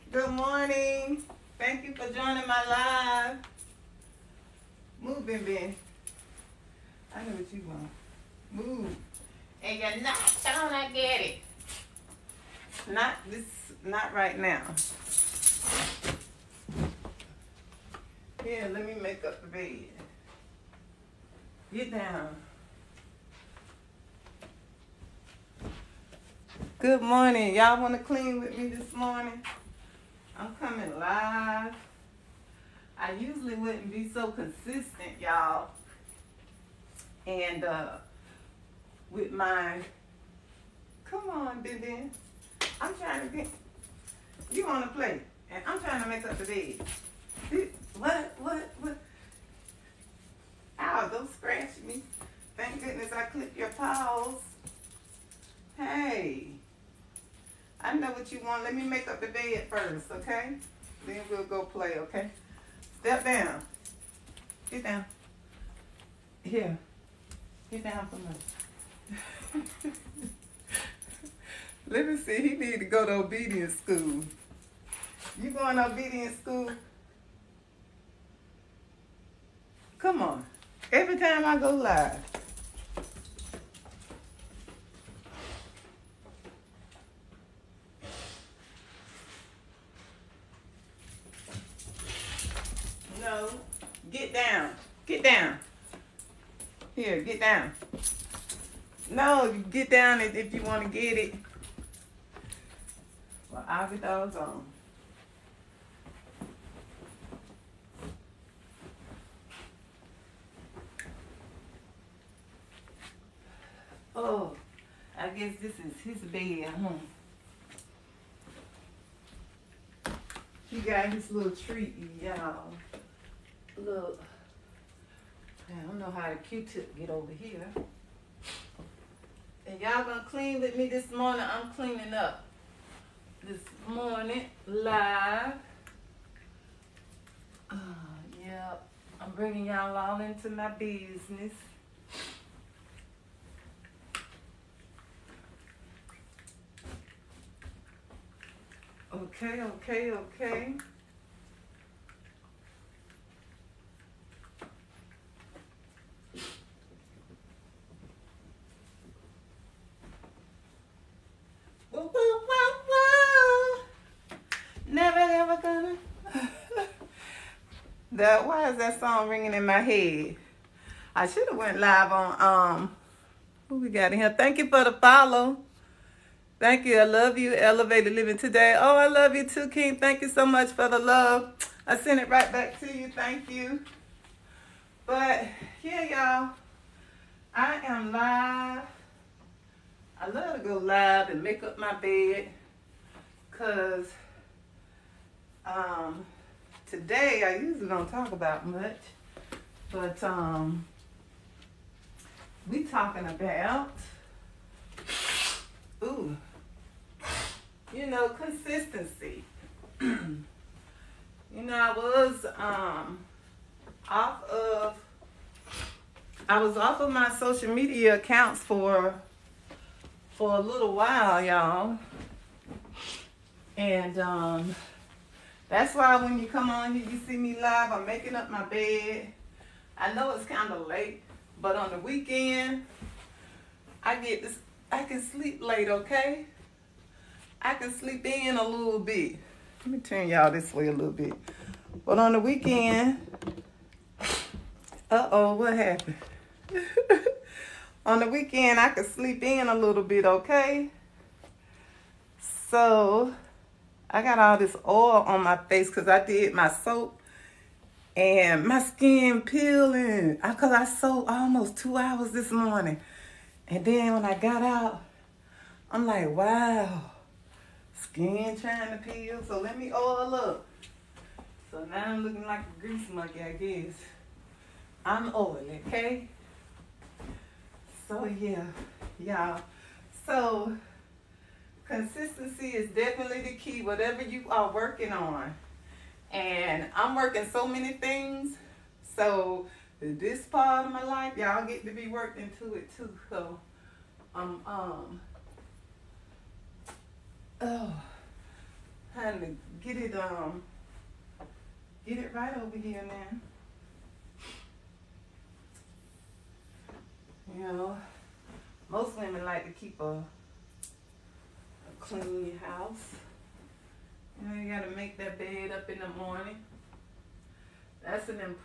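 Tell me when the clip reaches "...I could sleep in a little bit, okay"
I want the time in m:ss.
4:08.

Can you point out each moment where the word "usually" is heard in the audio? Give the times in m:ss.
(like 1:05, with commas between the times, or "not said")
0:33, 3:17.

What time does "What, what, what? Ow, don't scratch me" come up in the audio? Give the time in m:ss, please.
0:48.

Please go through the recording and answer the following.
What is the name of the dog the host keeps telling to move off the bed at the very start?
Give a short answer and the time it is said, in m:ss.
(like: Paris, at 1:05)
Ben Ben, at 0:05.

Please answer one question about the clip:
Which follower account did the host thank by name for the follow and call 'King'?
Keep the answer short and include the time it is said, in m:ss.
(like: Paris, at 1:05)
Elevated Living Today, at 2:57.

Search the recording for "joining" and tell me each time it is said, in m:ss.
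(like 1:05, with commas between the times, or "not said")
0:02.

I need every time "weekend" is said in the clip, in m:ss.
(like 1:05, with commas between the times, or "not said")
3:51, 4:02, 4:08.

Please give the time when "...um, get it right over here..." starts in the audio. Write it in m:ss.
5:00.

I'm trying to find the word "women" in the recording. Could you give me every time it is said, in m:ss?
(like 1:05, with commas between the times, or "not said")
5:09.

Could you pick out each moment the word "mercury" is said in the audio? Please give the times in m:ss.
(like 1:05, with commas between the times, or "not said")
not said.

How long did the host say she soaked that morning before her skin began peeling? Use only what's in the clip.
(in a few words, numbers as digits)
2 hours.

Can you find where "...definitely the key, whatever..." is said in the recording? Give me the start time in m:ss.
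4:42.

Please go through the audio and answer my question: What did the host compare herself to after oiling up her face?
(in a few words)
a grease monkey.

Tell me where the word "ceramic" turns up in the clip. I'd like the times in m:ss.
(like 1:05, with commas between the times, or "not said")
not said.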